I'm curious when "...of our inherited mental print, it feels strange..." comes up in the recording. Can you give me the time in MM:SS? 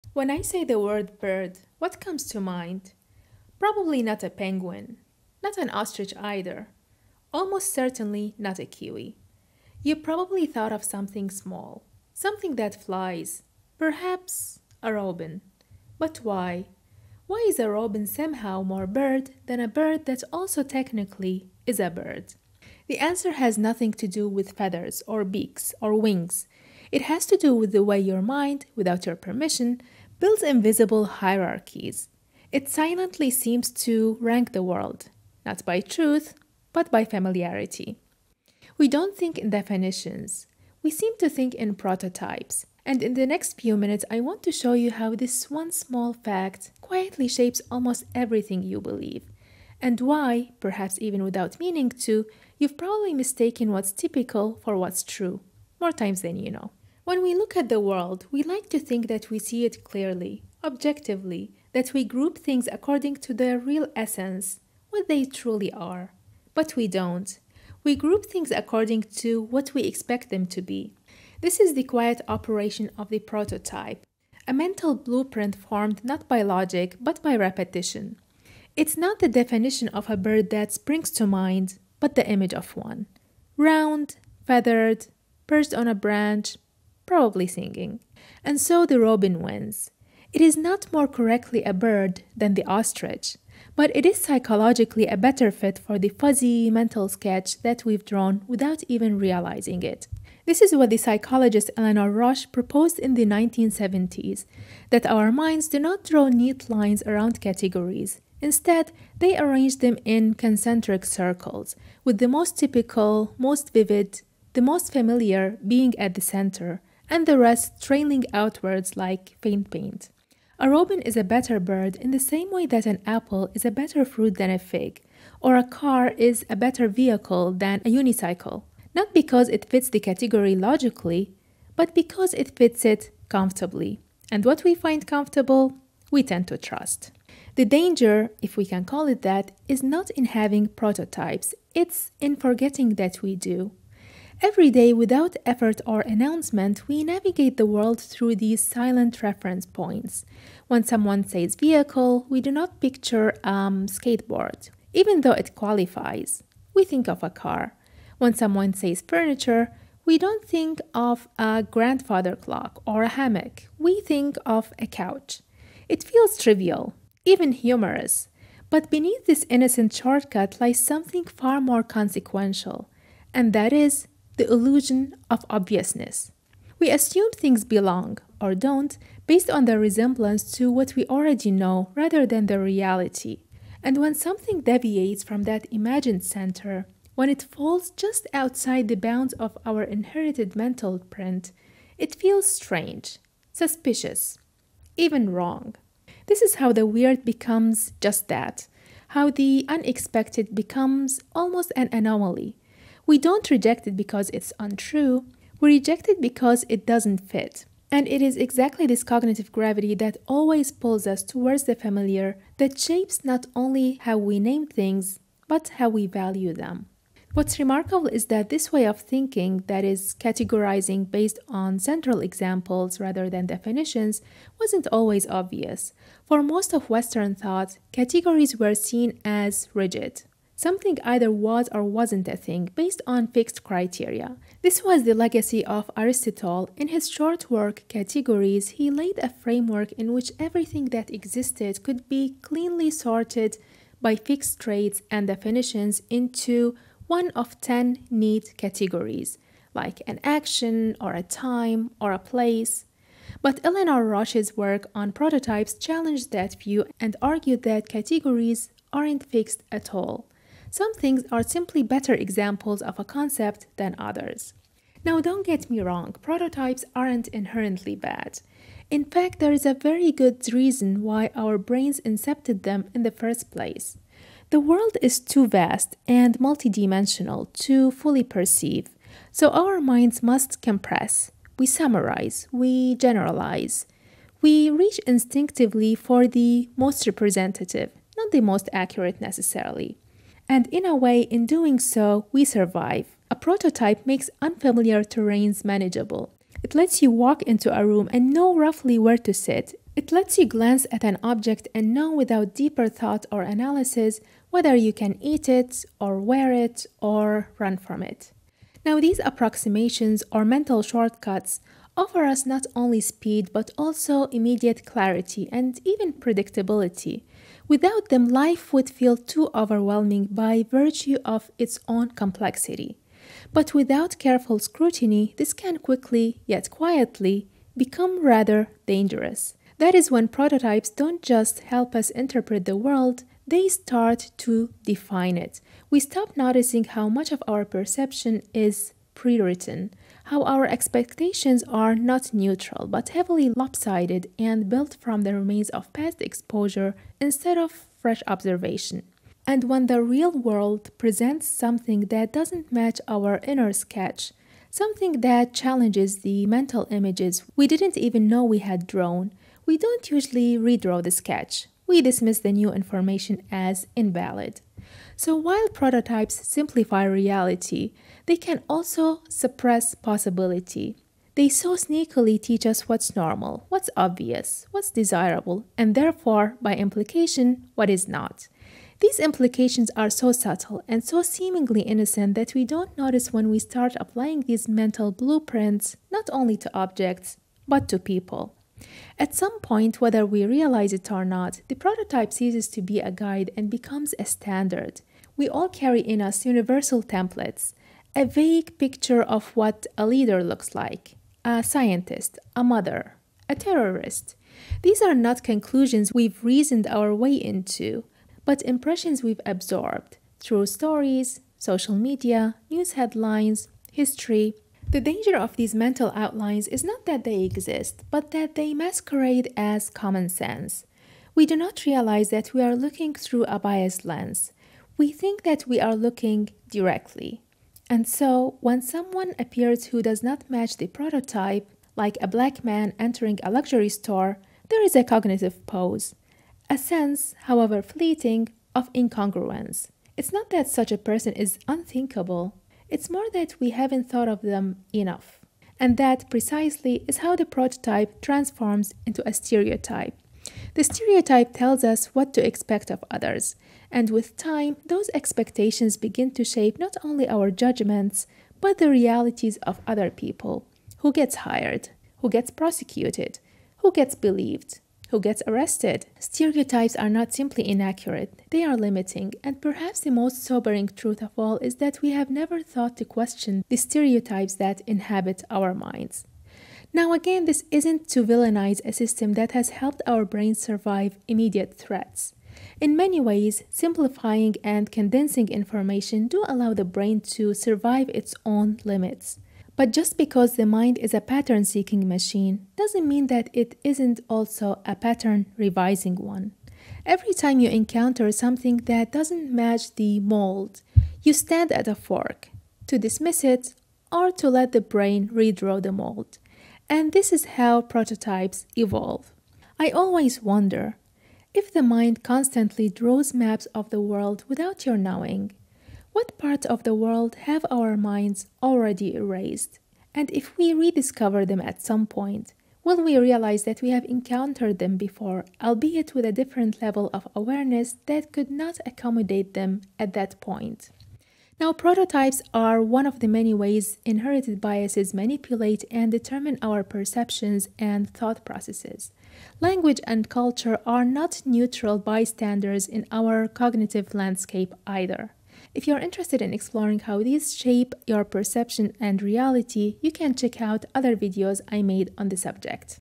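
03:09.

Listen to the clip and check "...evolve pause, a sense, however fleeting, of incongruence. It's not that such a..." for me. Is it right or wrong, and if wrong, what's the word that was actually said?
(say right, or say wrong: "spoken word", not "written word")
wrong: "cognitive", not "evolve".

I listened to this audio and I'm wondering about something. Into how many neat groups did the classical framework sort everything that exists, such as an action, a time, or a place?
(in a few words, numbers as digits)
10.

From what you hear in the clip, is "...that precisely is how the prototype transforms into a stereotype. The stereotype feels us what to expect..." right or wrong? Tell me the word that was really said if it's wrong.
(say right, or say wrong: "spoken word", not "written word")
wrong: "tells", not "feels".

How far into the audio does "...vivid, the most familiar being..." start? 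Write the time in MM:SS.
01:53.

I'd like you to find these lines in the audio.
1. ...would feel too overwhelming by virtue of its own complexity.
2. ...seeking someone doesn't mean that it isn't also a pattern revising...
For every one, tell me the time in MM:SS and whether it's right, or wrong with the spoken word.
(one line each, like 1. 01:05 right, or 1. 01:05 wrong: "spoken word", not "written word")
1. 05:18 right
2. 08:11 wrong: "machine", not "someone".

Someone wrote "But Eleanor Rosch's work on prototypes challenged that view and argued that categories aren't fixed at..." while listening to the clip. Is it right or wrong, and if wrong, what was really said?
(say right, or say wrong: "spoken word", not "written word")
right.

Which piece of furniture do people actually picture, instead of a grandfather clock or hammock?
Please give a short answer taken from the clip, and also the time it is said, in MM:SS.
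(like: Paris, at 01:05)
couch, at 02:44.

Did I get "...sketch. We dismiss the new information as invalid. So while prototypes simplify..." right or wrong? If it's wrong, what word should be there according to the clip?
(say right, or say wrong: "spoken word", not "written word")
right.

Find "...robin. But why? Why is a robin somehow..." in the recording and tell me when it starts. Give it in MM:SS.
00:14.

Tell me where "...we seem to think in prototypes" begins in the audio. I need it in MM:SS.
00:40.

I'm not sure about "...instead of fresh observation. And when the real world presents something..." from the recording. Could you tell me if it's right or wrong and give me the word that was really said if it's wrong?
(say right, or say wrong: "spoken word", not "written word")
right.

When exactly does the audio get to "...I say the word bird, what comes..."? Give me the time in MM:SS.
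00:00.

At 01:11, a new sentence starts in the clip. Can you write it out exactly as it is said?
This is the quiet operation of the prototype, a mental blueprint formed not by logic but by repetition.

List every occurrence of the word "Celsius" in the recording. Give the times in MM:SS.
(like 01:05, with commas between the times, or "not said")
not said.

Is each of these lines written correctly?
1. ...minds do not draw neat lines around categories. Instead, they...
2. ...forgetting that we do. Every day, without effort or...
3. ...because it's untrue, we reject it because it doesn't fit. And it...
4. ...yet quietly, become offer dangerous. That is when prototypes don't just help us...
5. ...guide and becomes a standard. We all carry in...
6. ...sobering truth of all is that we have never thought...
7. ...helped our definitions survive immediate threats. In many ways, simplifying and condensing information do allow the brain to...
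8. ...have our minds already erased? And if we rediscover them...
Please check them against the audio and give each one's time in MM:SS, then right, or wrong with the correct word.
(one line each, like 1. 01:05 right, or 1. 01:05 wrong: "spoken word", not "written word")
1. 01:45 right
2. 02:22 right
3. 03:23 right
4. 05:26 wrong: "rather", not "offer"
5. 06:33 right
6. 07:50 right
7. 07:59 wrong: "brains", not "definitions"
8. 08:37 right.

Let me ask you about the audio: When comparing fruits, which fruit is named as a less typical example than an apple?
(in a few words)
fig.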